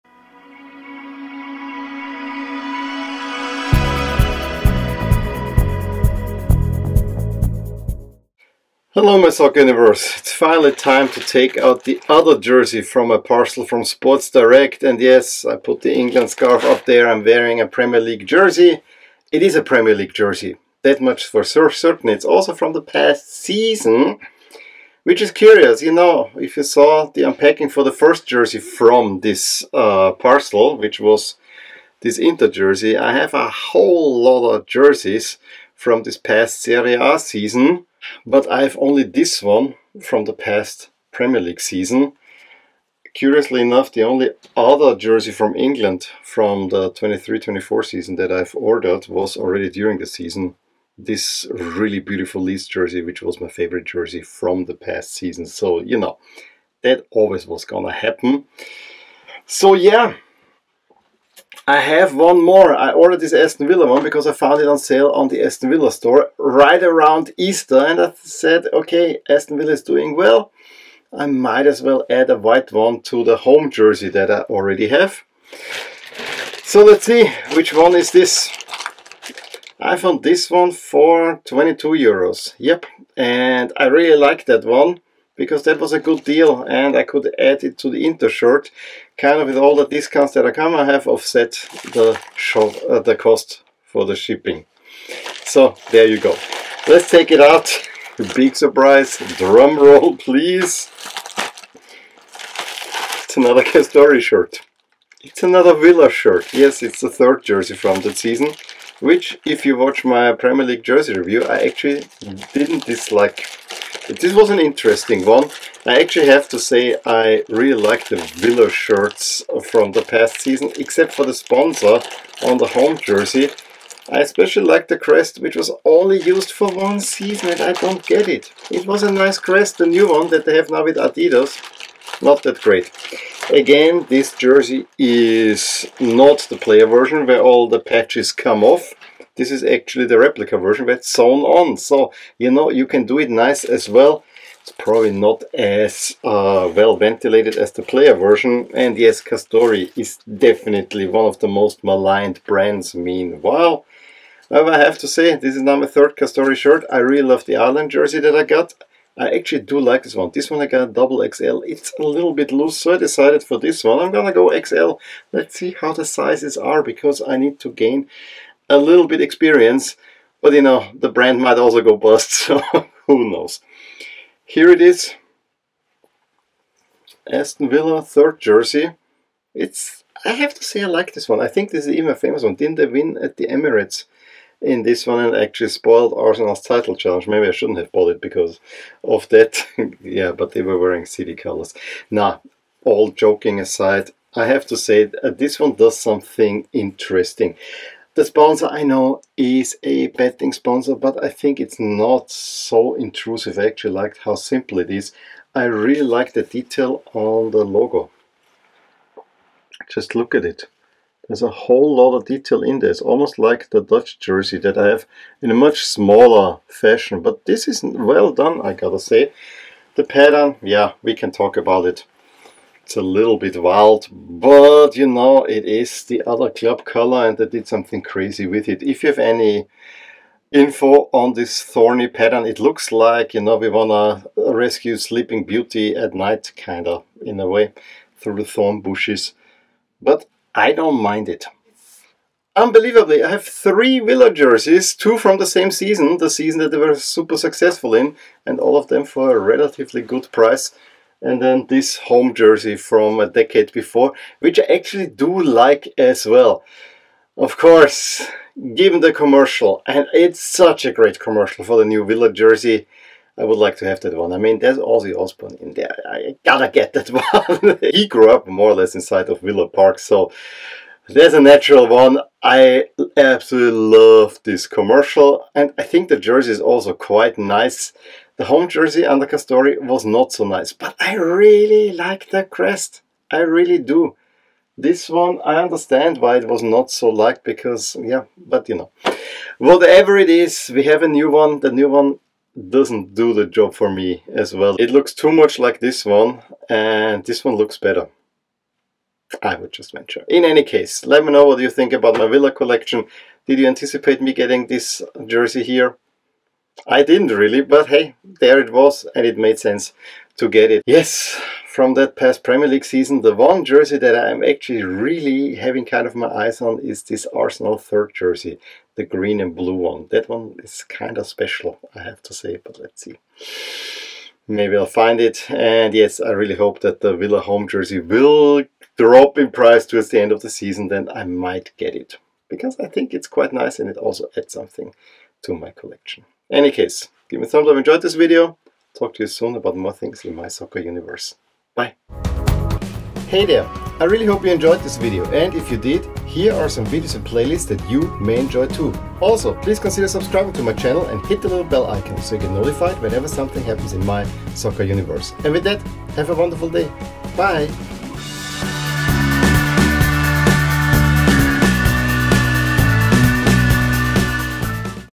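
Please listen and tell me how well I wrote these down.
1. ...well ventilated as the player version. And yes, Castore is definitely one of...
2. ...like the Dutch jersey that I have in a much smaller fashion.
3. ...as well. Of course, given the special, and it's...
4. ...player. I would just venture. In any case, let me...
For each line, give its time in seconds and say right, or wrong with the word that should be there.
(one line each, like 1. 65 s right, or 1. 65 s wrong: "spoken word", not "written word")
1. 146 s right
2. 213 s right
3. 255 s wrong: "commercial", not "special"
4. 297 s wrong: "better", not "player".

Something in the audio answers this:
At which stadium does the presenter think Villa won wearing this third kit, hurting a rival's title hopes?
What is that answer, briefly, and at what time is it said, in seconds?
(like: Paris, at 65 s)
the Emirates, at 183 s.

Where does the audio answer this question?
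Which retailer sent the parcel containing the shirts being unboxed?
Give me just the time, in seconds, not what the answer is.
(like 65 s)
13 s.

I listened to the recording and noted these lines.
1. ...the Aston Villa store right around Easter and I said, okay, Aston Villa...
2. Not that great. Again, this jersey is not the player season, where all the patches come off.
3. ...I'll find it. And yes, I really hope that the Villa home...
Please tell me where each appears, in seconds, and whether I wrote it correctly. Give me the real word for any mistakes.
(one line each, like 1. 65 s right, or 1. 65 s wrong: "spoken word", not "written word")
1. 65 s right
2. 132 s wrong: "version", not "season"
3. 324 s right.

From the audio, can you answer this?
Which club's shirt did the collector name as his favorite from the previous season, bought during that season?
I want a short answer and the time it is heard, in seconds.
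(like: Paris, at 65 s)
Leeds, at 52 s.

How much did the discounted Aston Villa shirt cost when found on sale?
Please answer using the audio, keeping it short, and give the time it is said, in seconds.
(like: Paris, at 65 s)
22 euros, at 81 s.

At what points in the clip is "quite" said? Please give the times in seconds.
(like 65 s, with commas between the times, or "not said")
276 s, 333 s.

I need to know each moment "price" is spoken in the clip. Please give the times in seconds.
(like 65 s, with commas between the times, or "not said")
250 s, 329 s.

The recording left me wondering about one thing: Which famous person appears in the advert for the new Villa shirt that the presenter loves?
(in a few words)
Ozzy Osbourne.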